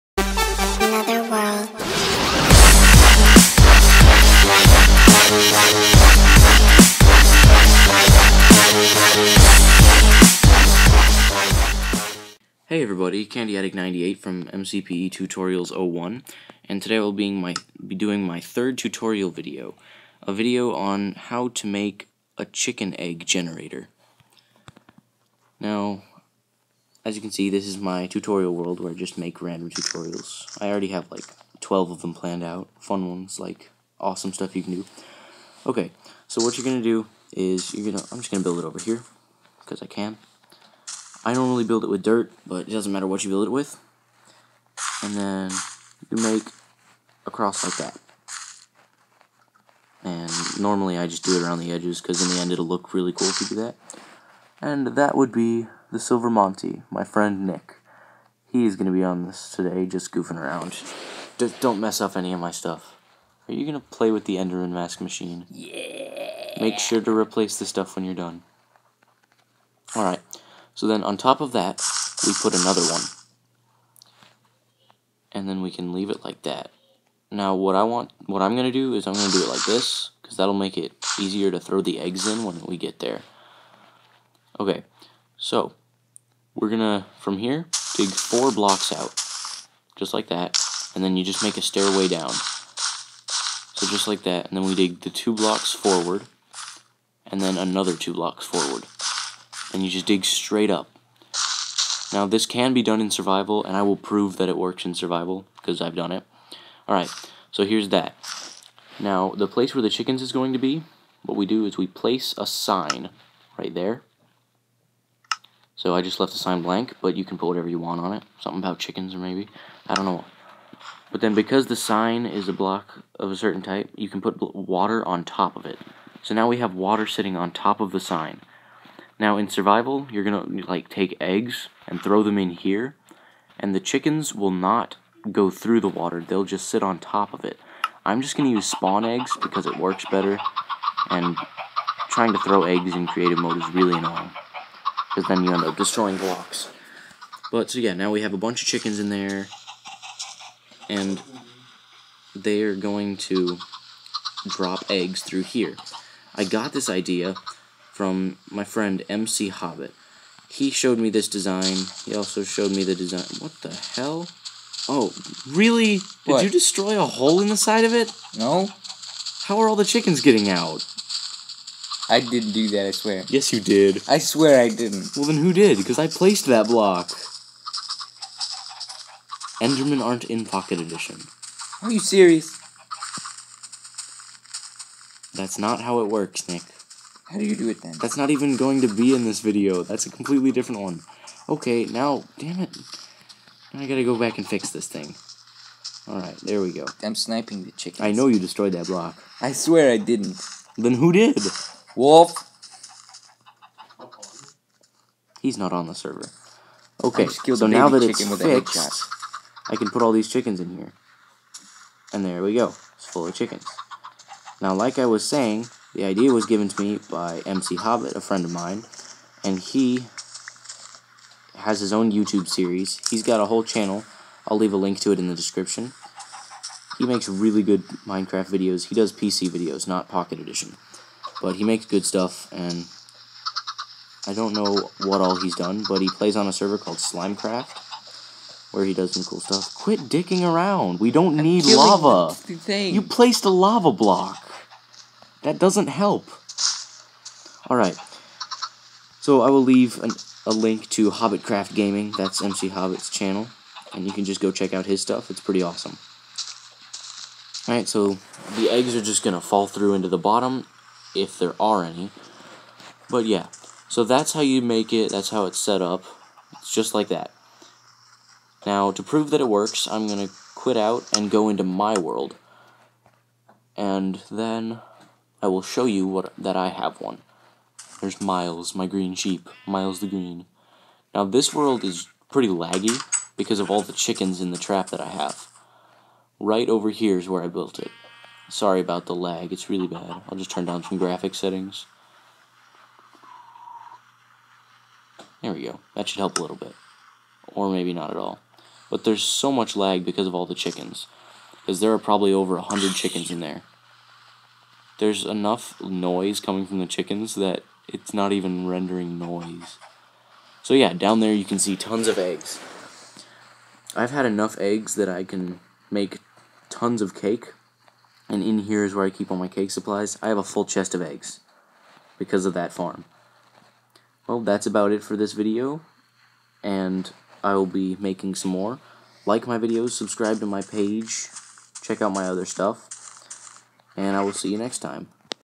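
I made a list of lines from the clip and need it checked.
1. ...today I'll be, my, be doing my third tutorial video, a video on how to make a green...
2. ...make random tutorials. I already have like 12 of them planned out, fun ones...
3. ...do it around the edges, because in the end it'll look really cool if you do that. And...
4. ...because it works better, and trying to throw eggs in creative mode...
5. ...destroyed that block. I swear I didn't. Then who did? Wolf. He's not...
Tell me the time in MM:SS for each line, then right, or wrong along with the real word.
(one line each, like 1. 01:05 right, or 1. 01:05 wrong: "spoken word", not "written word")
1. 00:16 wrong: "chicken", not "green"
2. 00:29 right
3. 00:51 right
4. 02:19 right
5. 03:18 right.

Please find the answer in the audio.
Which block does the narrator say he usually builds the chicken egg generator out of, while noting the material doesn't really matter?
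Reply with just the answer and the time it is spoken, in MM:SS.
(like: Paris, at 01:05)
dirt, at 00:42.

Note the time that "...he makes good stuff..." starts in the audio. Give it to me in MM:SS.
03:51.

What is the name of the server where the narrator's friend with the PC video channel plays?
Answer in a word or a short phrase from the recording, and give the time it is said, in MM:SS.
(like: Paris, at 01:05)
Slimecraft, at 03:56.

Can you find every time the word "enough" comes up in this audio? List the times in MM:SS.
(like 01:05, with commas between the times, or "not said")
05:05, 05:14.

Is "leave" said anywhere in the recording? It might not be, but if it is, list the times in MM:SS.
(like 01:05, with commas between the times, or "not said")
01:15, 03:44, 04:09.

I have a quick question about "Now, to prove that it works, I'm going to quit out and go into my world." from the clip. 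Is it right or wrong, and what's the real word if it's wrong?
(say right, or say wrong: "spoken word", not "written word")
right.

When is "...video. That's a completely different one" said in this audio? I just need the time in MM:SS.
03:09.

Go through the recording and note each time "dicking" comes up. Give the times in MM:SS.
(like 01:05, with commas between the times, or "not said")
04:00.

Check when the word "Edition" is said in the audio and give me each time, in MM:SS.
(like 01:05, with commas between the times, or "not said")
03:00, 03:50.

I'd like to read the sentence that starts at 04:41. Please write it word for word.
Now this world is pretty laggy because of all the chickens in the trap that I have.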